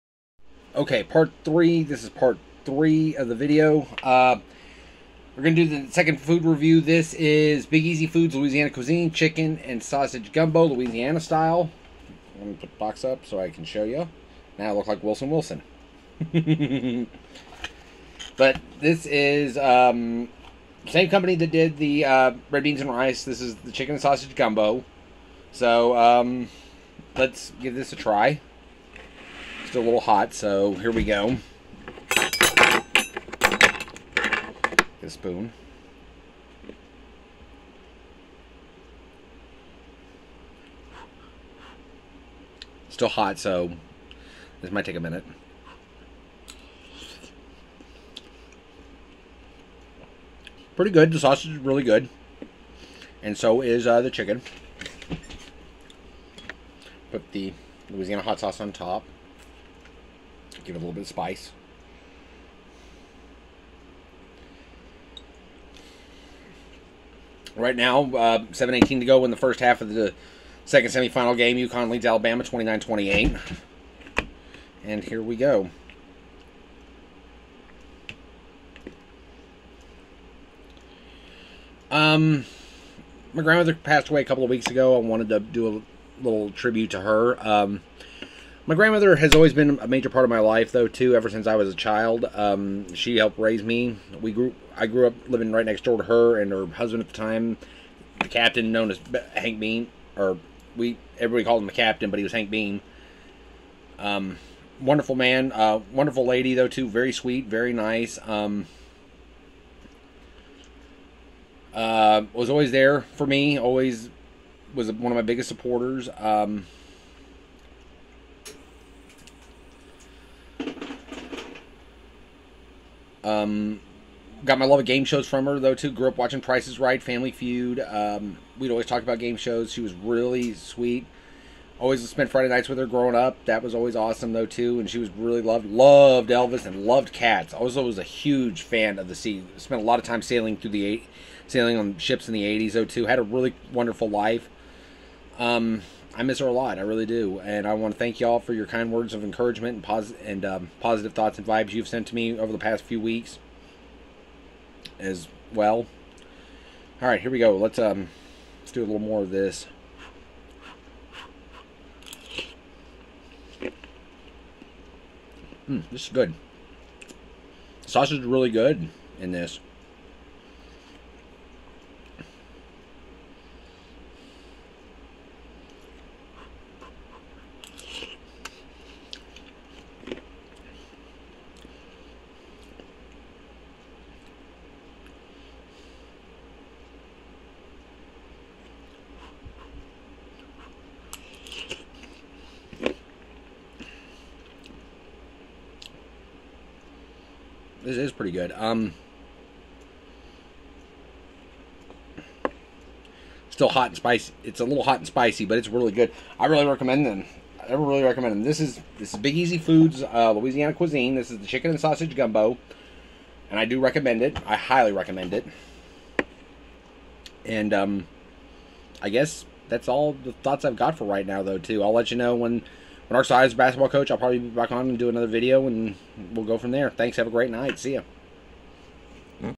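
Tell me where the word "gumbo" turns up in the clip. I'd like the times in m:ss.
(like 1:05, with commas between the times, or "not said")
0:10, 0:24, 3:32.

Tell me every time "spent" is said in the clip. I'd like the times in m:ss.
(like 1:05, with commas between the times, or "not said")
2:12, 2:19.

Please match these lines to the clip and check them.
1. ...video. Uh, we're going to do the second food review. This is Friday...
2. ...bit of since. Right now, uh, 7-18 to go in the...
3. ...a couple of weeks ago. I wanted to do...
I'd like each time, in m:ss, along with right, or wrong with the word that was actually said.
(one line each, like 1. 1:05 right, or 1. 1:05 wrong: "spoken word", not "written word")
1. 0:03 wrong: "Big", not "Friday"
2. 1:00 wrong: "spice", not "since"
3. 1:24 right.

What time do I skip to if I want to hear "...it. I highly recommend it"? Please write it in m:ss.
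3:34.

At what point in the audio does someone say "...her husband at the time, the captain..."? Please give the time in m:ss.
1:36.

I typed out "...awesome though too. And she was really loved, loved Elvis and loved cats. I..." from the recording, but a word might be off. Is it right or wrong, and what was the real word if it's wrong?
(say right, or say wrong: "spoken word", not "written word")
right.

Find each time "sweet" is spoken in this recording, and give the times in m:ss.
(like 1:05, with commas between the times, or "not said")
1:47, 2:10.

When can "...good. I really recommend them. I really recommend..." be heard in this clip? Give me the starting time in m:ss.
3:25.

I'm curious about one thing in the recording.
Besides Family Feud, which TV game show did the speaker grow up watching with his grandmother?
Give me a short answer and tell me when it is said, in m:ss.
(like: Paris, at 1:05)
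Price Is Right, at 2:06.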